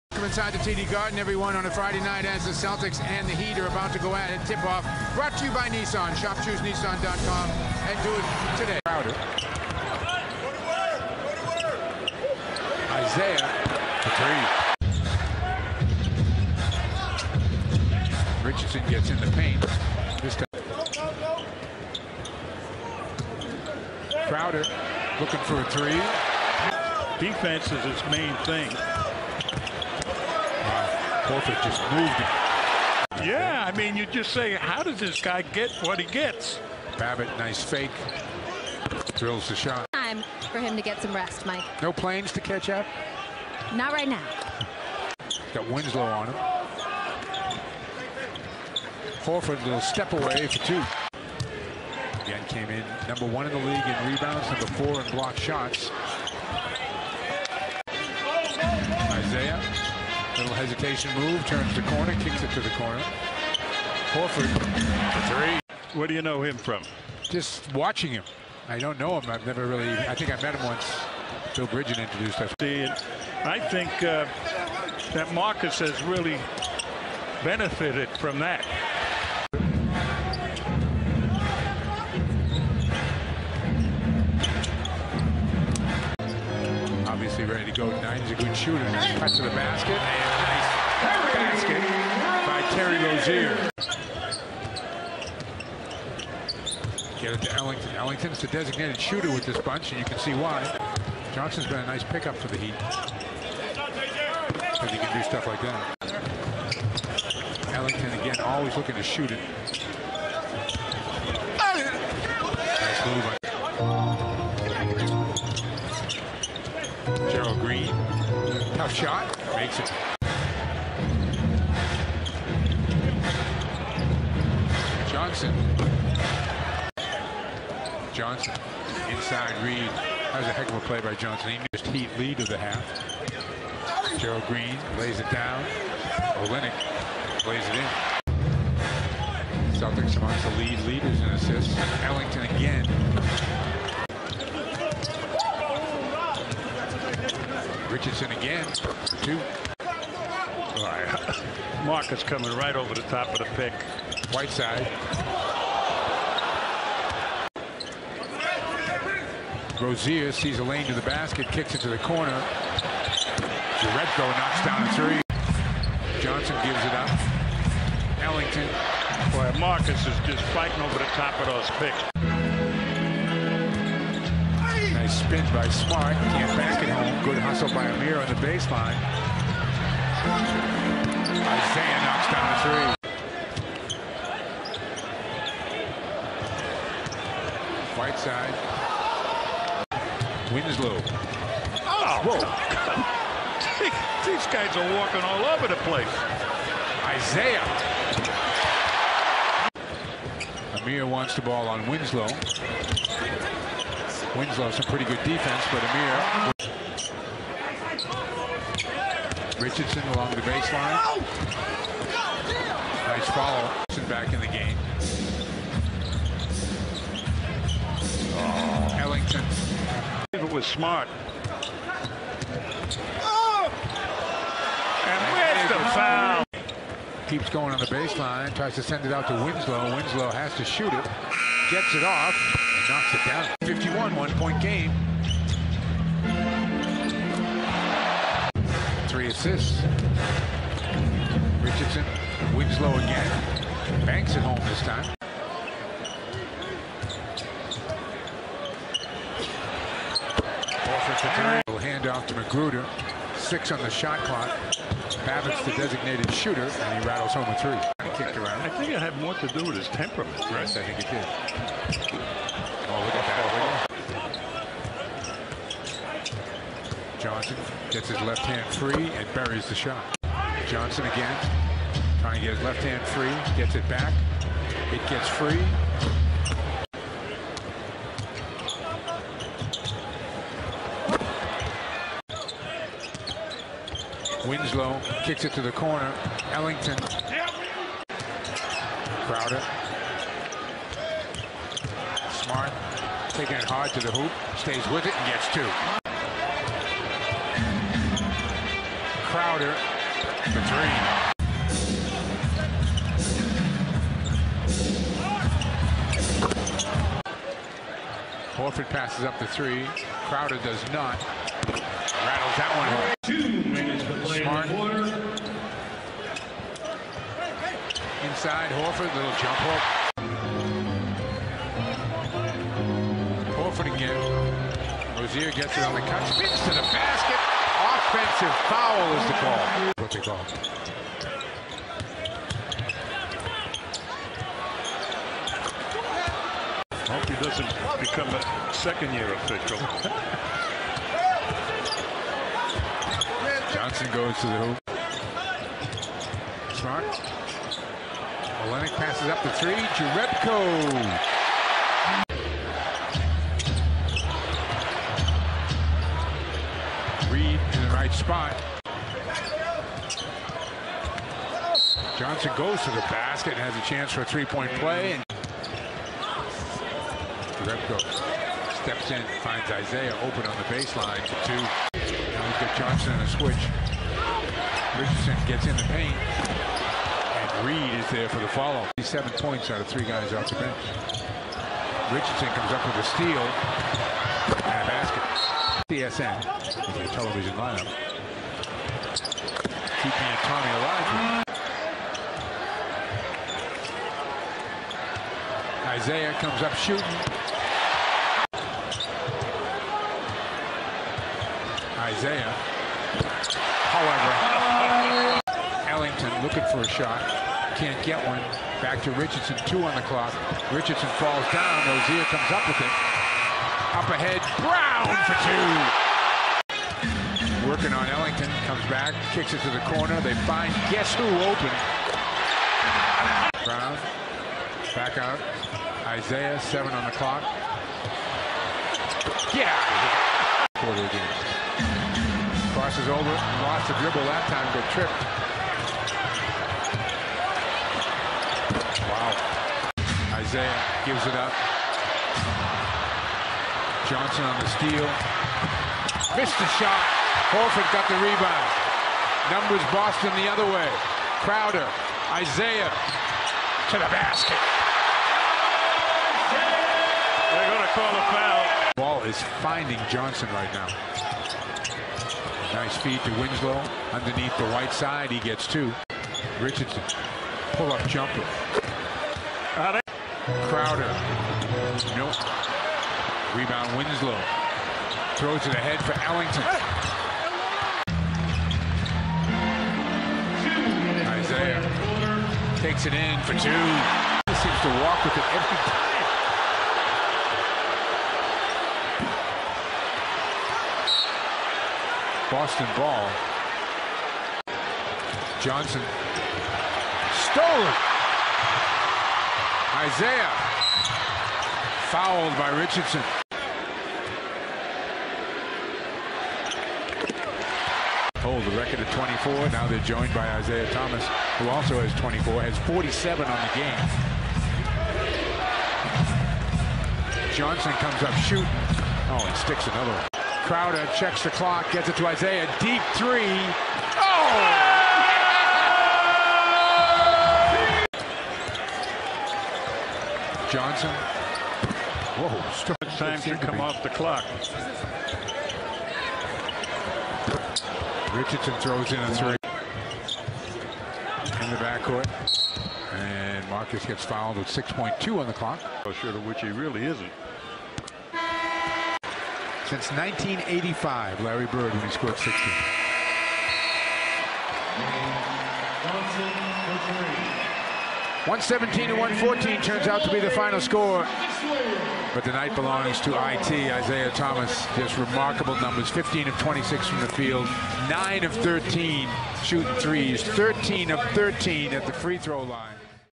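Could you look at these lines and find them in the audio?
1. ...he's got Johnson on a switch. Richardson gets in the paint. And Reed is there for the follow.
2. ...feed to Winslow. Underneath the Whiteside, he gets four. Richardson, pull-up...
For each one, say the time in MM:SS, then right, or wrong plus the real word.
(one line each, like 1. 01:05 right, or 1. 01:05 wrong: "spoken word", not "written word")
1. 06:12 right
2. 07:42 wrong: "two", not "four".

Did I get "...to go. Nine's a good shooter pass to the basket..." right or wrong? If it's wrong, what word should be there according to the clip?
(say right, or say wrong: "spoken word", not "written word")
right.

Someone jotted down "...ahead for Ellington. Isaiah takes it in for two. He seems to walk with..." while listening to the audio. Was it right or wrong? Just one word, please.
right.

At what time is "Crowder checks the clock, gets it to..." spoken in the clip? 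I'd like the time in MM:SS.
08:40.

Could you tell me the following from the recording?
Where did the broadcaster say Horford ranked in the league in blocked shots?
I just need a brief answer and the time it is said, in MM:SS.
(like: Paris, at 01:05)
number four, at 00:54.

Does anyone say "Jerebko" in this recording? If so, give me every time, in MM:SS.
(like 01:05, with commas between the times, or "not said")
02:43, 05:49, 06:07.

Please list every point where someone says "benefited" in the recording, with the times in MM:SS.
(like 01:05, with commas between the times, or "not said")
01:17.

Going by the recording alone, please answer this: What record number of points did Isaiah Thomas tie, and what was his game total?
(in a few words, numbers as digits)
24; 47.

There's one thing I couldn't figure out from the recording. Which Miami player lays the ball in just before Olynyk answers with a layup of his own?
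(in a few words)
Gerald Green.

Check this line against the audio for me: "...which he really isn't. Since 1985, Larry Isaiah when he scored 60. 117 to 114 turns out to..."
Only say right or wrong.
wrong.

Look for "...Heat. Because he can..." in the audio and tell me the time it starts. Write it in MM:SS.
01:42.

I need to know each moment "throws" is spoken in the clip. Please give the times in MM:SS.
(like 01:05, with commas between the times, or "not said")
07:55, 08:58, 09:32.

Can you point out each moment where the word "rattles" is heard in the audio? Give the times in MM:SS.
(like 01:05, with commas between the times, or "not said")
04:17, 05:12.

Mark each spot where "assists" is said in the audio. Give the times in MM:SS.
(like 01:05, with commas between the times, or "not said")
02:21, 03:59.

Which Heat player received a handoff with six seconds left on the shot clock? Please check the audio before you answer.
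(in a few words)
McGruder.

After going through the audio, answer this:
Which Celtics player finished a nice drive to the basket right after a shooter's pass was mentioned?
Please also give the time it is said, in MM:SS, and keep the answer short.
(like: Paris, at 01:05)
Terry Rozier, at 01:32.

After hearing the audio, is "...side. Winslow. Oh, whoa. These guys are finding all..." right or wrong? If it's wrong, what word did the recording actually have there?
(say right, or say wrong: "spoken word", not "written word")
wrong: "walking", not "finding".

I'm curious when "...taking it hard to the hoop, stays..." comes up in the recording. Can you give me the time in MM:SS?
04:53.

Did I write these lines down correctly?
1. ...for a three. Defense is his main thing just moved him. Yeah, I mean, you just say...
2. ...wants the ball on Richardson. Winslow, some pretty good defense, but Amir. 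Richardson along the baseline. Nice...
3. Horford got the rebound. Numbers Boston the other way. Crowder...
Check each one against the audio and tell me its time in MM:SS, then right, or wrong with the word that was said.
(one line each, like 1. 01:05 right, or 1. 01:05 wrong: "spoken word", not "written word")
1. 00:25 right
2. 03:21 wrong: "Winslow", not "Richardson"
3. 07:27 right.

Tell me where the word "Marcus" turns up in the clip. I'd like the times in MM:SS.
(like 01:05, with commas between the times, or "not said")
01:15, 02:31, 02:49, 09:03.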